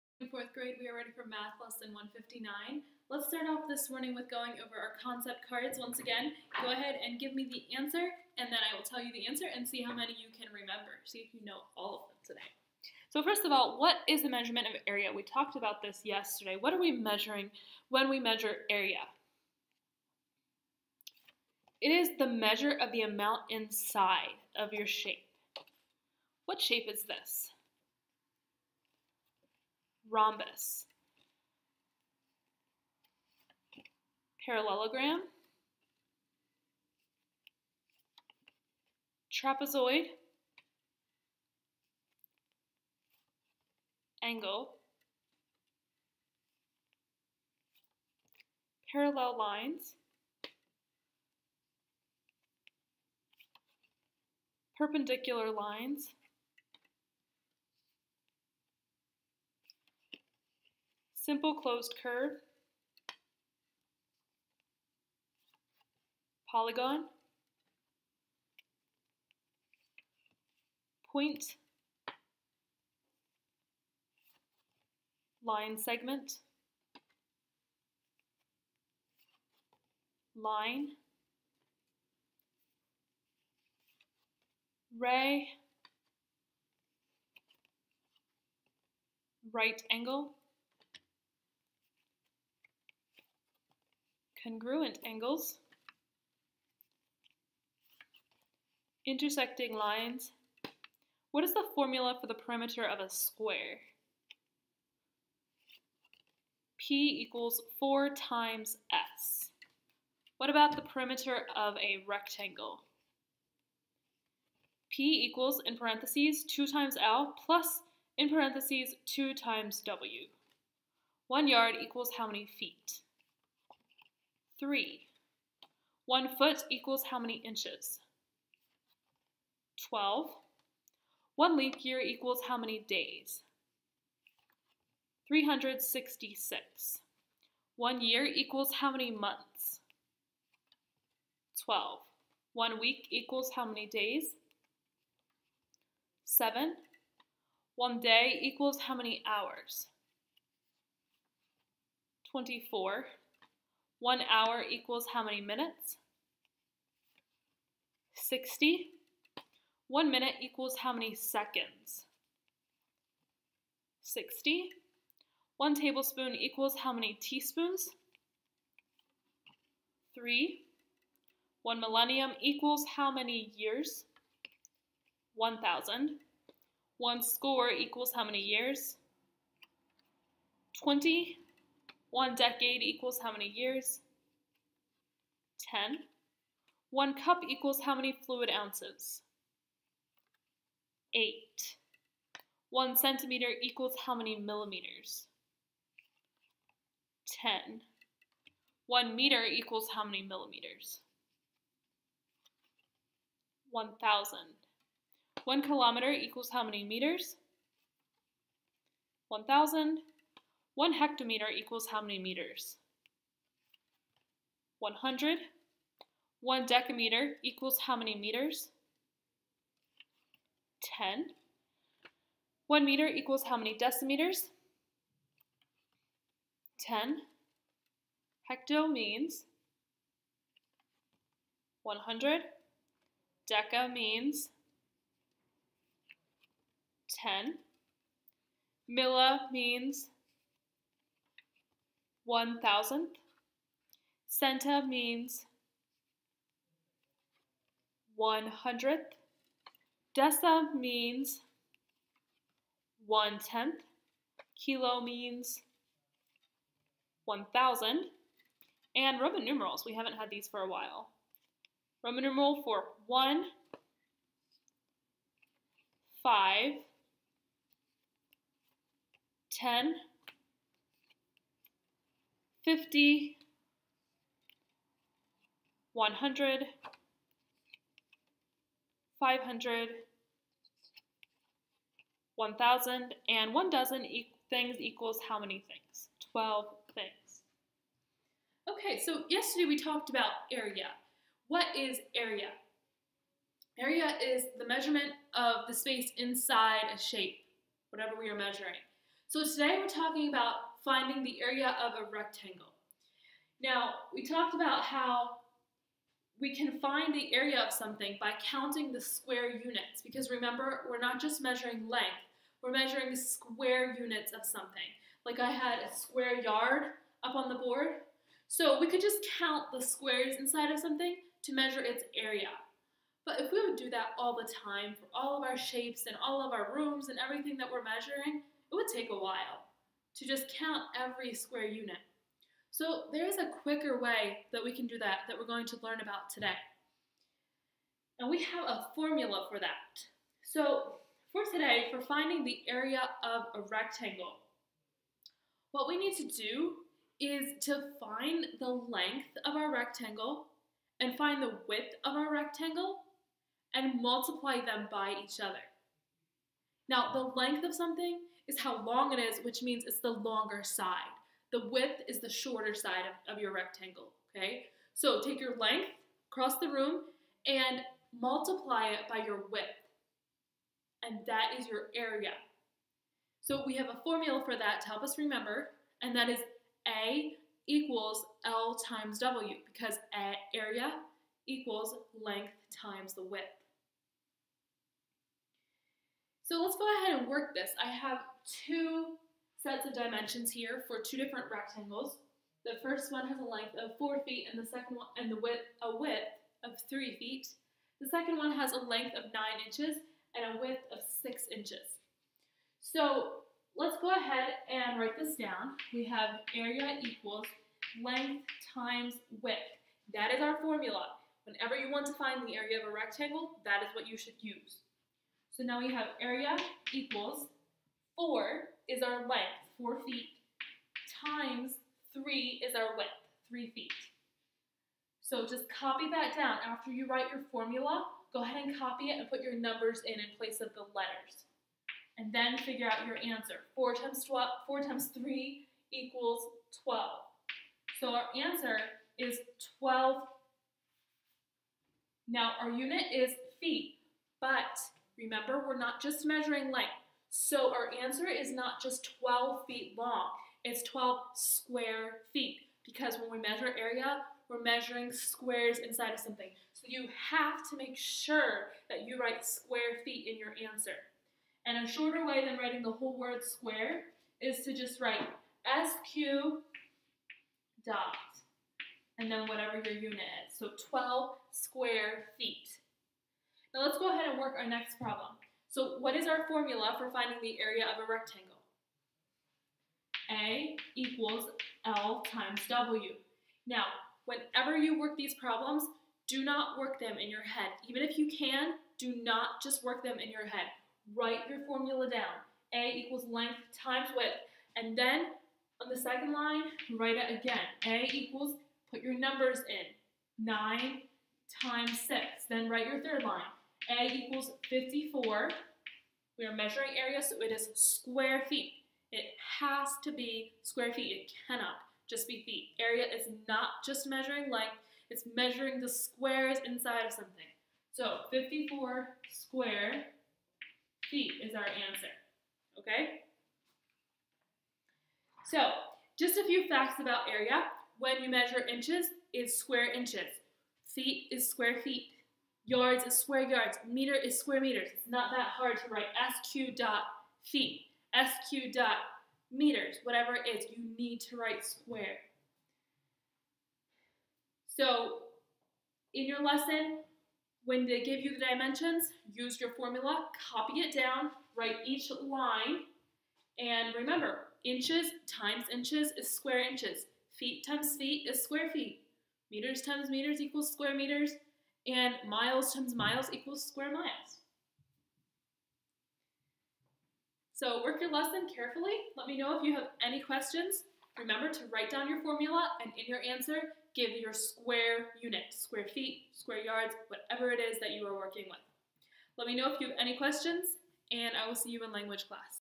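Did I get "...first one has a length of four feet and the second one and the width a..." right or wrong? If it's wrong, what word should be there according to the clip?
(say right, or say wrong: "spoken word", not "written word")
right.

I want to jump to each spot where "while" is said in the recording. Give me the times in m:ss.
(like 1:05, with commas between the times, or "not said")
4:20, 5:29.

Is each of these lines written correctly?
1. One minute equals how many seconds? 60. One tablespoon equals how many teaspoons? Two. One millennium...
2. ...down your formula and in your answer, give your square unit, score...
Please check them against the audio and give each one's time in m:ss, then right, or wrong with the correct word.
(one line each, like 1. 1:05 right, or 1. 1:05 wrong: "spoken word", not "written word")
1. 2:39 wrong: "Three", not "Two"
2. 9:31 wrong: "square", not "score".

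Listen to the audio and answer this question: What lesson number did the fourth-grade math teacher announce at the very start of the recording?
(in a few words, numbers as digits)
159.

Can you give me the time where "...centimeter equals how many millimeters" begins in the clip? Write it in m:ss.
3:12.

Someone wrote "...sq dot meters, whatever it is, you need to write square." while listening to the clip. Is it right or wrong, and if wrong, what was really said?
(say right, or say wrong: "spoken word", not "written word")
right.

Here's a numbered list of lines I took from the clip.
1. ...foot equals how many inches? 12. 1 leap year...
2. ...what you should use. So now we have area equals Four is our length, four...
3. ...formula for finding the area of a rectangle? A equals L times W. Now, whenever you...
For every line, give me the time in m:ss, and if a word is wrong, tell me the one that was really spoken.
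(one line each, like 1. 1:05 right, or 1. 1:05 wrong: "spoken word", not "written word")
1. 2:06 right
2. 6:53 right
3. 7:56 right.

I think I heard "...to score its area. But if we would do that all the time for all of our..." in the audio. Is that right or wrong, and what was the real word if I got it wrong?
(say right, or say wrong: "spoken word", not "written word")
wrong: "measure", not "score".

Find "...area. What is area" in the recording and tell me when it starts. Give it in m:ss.
4:50.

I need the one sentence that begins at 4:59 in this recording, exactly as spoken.
So today we're talking about finding the area of a rectangle.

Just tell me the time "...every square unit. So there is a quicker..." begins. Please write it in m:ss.
5:31.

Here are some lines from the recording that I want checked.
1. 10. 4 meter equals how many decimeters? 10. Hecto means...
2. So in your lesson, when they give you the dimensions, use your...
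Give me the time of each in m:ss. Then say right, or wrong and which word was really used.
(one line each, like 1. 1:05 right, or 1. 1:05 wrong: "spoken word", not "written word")
1. 3:40 wrong: "1", not "4"
2. 9:04 right.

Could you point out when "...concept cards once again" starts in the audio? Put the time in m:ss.
0:05.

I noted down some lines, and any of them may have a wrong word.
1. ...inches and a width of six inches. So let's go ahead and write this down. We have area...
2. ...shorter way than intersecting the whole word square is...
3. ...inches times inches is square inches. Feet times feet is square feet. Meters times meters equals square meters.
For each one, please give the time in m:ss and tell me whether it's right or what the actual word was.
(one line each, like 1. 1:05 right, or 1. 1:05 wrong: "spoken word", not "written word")
1. 6:39 right
2. 7:41 wrong: "writing", not "intersecting"
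3. 9:14 right.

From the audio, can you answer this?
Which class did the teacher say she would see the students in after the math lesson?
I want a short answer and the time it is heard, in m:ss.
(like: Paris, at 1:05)
language class, at 9:41.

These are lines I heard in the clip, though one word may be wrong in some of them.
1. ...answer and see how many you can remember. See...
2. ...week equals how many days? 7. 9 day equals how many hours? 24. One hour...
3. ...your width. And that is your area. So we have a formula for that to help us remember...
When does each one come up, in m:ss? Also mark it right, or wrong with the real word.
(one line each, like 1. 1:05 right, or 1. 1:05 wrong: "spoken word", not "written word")
1. 0:09 right
2. 2:22 wrong: "1", not "9"
3. 6:09 right.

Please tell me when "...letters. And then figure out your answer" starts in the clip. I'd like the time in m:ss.
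7:10.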